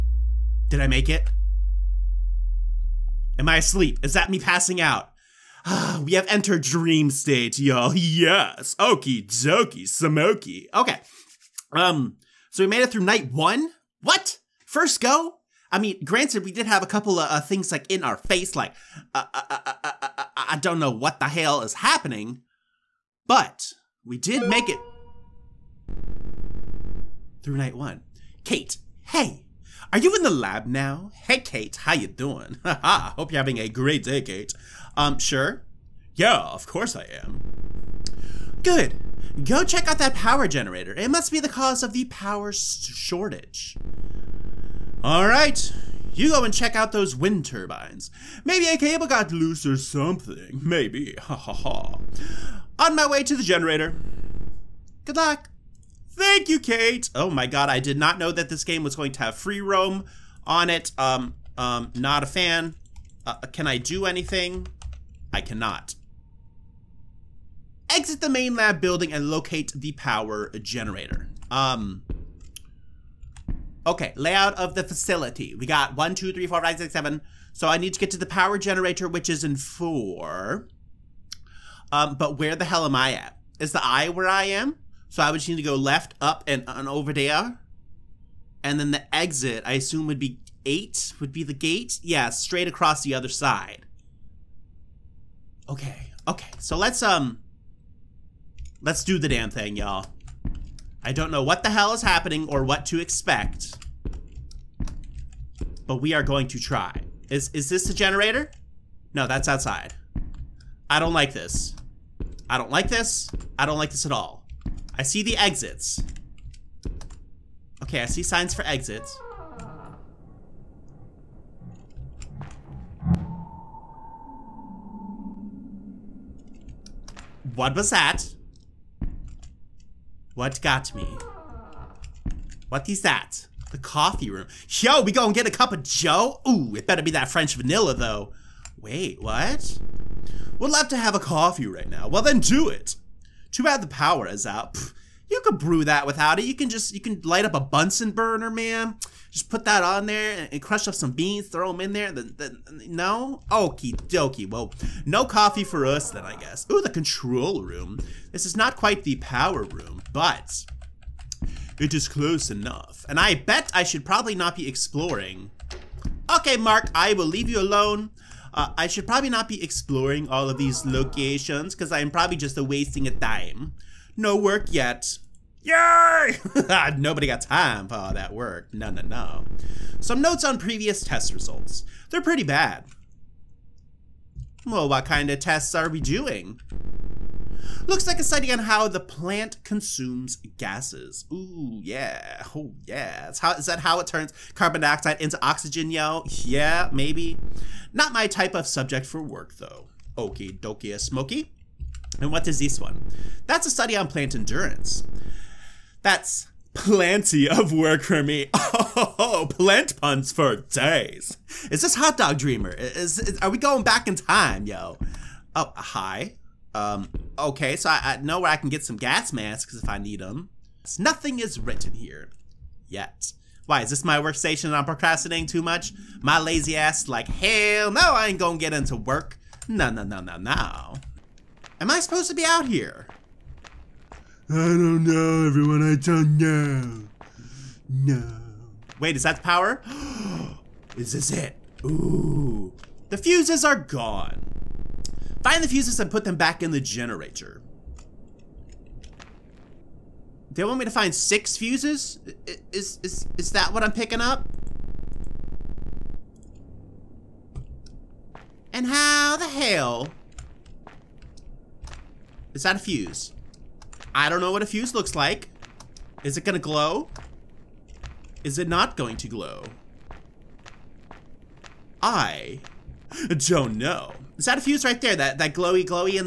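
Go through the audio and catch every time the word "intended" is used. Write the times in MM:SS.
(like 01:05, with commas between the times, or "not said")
not said.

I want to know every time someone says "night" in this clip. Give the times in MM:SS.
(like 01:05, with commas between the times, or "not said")
00:13, 00:27.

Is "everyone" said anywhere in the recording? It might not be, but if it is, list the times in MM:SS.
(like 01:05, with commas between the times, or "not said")
03:55.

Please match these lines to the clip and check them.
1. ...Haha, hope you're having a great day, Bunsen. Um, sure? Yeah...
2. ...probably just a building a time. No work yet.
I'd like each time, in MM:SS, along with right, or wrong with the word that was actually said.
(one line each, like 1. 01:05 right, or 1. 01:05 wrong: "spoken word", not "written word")
1. 00:32 wrong: "Kate", not "Bunsen"
2. 02:52 wrong: "wasting", not "building".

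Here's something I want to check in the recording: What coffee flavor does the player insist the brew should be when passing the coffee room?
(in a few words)
French vanilla.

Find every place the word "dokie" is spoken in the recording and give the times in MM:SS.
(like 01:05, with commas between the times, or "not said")
00:09, 02:33, 03:20.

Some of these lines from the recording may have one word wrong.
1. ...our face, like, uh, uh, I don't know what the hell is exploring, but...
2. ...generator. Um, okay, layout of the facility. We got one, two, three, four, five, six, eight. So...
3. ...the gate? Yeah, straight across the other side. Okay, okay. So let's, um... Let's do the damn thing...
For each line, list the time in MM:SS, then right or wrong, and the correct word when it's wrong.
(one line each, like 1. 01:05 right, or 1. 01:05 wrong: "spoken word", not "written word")
1. 00:18 wrong: "happening", not "exploring"
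2. 01:10 wrong: "seven", not "eight"
3. 01:31 right.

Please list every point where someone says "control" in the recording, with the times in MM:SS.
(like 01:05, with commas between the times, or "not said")
02:36.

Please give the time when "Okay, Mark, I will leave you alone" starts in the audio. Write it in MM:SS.
02:46.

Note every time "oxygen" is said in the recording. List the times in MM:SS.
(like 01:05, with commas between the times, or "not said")
03:15.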